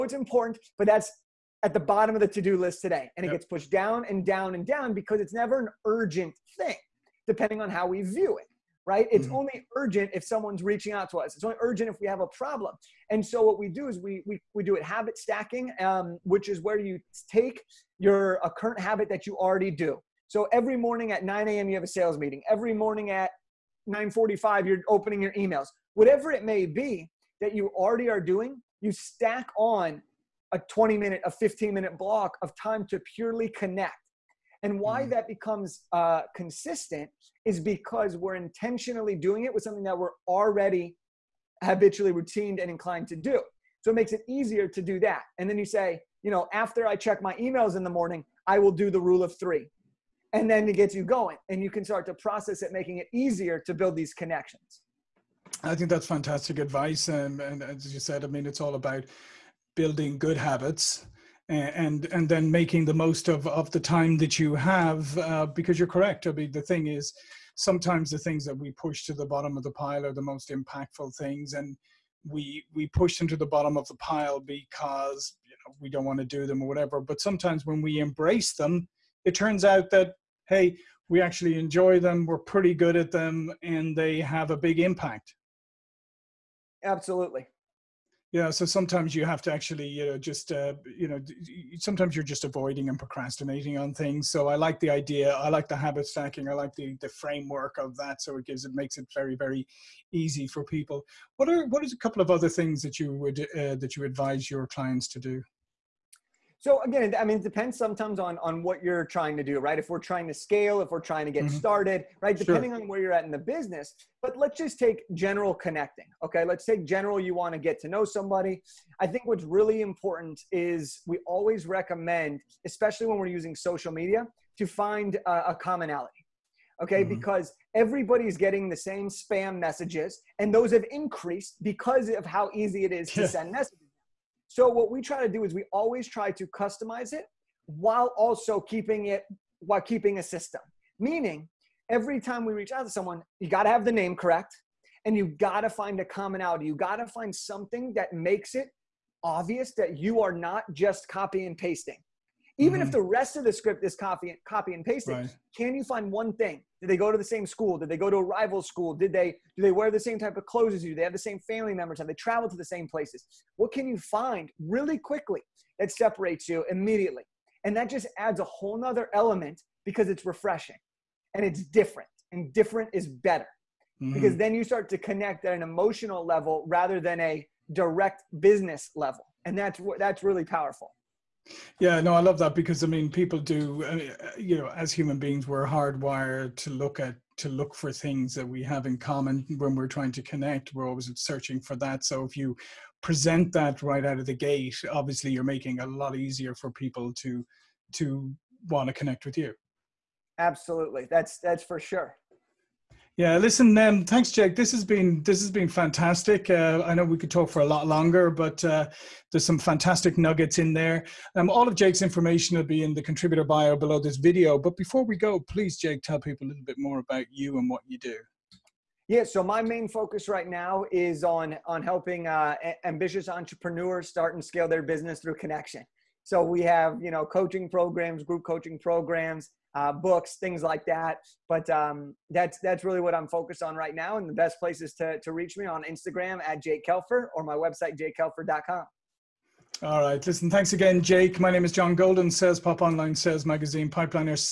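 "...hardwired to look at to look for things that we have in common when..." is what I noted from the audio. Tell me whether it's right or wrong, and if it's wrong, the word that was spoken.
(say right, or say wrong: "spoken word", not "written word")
right.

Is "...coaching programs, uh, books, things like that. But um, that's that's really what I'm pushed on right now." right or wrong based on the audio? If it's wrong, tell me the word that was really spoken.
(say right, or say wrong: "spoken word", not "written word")
wrong: "focused", not "pushed".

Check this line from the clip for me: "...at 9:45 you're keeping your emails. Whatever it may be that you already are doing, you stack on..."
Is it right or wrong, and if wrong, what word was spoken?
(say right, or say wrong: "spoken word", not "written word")
wrong: "opening", not "keeping".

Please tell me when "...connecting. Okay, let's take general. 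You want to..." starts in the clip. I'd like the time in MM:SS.
01:55.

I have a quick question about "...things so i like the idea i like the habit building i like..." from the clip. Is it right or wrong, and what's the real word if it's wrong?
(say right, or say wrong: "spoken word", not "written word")
wrong: "stacking", not "building".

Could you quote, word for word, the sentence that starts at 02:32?
if the rest of the script is copy and copy and pasting right.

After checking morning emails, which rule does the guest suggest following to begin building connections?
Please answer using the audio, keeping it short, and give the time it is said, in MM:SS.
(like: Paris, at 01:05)
the rule of three, at 00:48.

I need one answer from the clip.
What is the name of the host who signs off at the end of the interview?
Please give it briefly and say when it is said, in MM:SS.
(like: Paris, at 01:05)
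John Golden, at 04:01.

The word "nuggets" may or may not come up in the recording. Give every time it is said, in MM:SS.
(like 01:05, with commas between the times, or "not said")
03:30.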